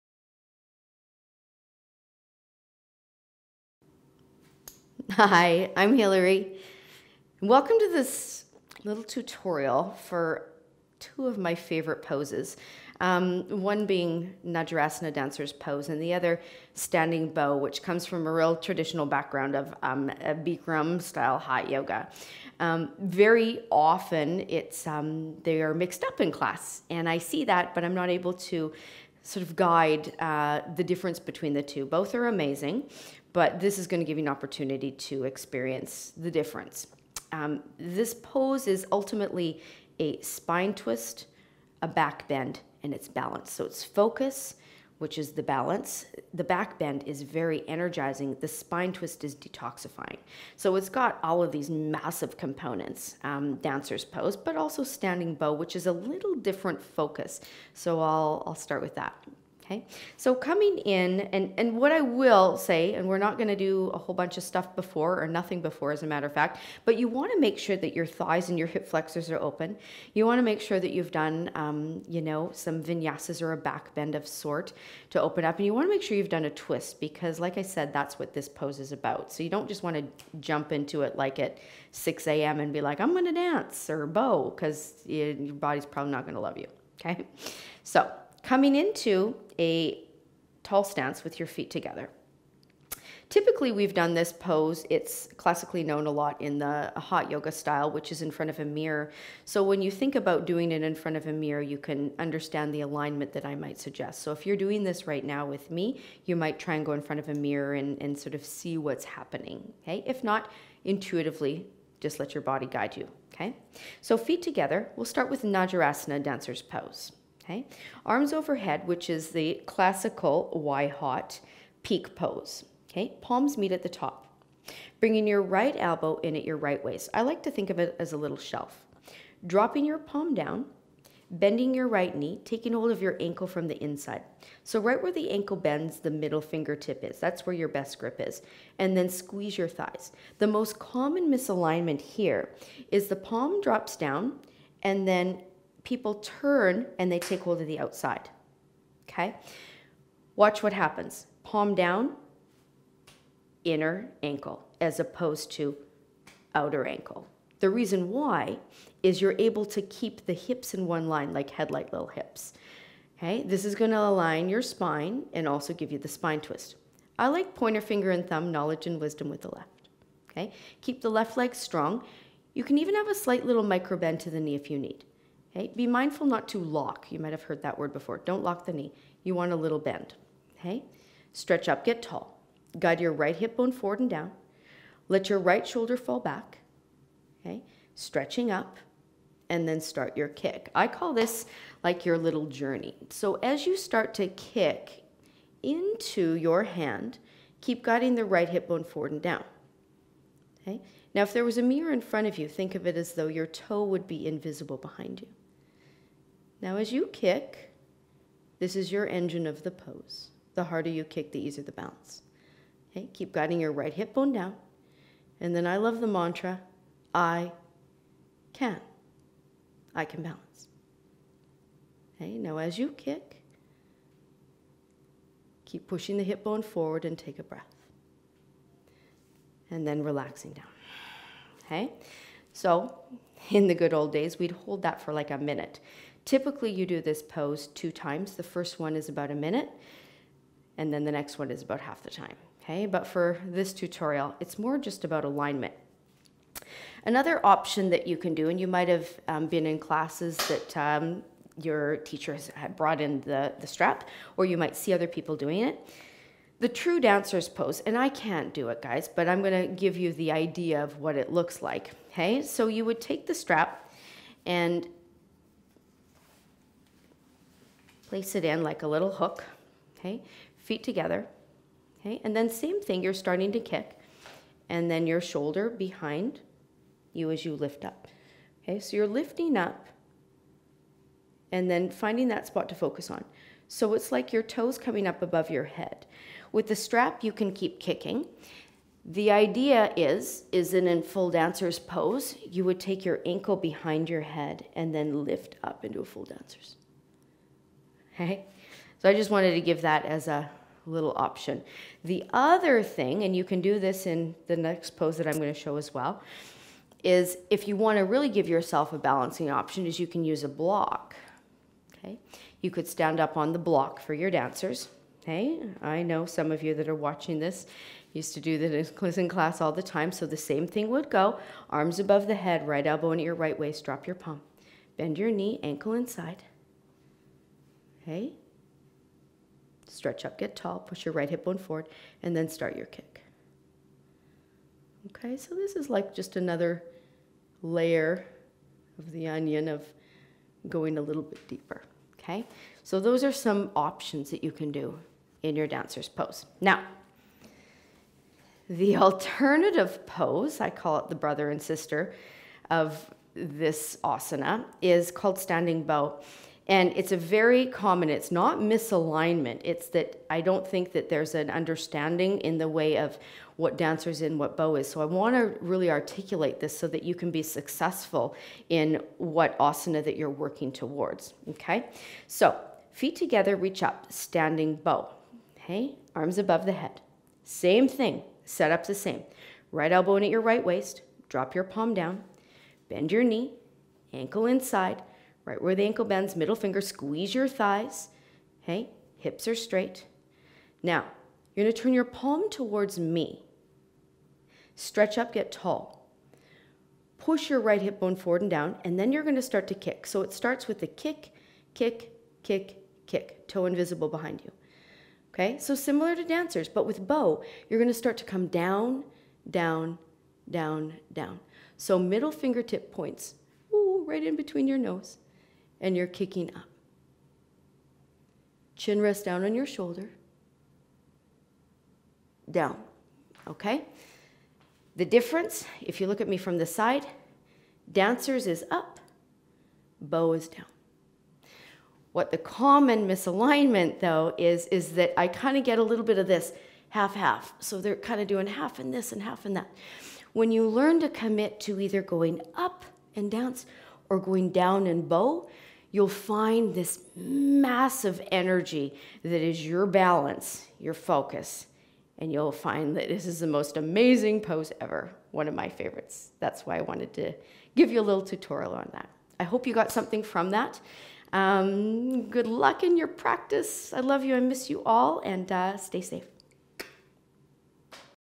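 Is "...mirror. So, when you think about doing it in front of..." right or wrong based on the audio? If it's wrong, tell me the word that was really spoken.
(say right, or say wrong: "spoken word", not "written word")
right.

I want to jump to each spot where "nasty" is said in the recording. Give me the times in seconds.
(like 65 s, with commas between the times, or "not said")
not said.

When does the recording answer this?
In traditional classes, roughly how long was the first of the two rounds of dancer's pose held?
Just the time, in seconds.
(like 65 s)
239 s.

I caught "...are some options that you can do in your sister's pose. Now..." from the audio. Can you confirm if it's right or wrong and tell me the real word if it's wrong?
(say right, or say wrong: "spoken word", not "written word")
wrong: "dancer", not "sister".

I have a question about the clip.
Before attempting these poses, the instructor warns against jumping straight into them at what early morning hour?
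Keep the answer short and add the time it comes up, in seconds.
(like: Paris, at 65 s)
6 a.m., at 81 s.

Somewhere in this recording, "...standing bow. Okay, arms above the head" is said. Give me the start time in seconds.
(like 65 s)
374 s.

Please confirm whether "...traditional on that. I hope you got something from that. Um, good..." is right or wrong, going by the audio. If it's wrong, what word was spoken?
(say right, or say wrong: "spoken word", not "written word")
wrong: "tutorial", not "traditional".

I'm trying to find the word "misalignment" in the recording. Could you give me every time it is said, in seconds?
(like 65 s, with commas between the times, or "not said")
141 s, 358 s, 433 s.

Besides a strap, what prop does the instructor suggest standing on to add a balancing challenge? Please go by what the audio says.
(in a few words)
A block.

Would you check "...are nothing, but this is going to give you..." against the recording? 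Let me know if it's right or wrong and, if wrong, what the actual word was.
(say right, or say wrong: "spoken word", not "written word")
wrong: "amazing", not "nothing".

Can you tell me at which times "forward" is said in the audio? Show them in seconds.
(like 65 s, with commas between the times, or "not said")
183 s, 198 s, 226 s, 331 s, 398 s.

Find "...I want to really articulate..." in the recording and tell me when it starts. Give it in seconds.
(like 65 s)
365 s.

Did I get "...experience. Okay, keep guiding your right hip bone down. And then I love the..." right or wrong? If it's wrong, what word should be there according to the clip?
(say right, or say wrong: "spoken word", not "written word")
wrong: "bounce", not "experience".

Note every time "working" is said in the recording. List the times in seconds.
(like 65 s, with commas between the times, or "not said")
370 s.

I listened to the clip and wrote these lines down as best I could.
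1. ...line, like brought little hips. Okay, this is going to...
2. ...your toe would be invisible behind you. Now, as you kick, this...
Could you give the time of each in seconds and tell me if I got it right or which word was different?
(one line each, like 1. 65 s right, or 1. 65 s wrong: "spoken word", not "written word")
1. 161 s wrong: "headlight", not "brought"
2. 203 s right.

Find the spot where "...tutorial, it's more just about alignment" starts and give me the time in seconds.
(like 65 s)
243 s.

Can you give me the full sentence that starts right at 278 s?
So you're lifting up and then finding that spot to focus on.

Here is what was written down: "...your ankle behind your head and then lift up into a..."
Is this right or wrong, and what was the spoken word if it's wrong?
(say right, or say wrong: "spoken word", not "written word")
right.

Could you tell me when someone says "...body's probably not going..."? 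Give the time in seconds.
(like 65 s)
85 s.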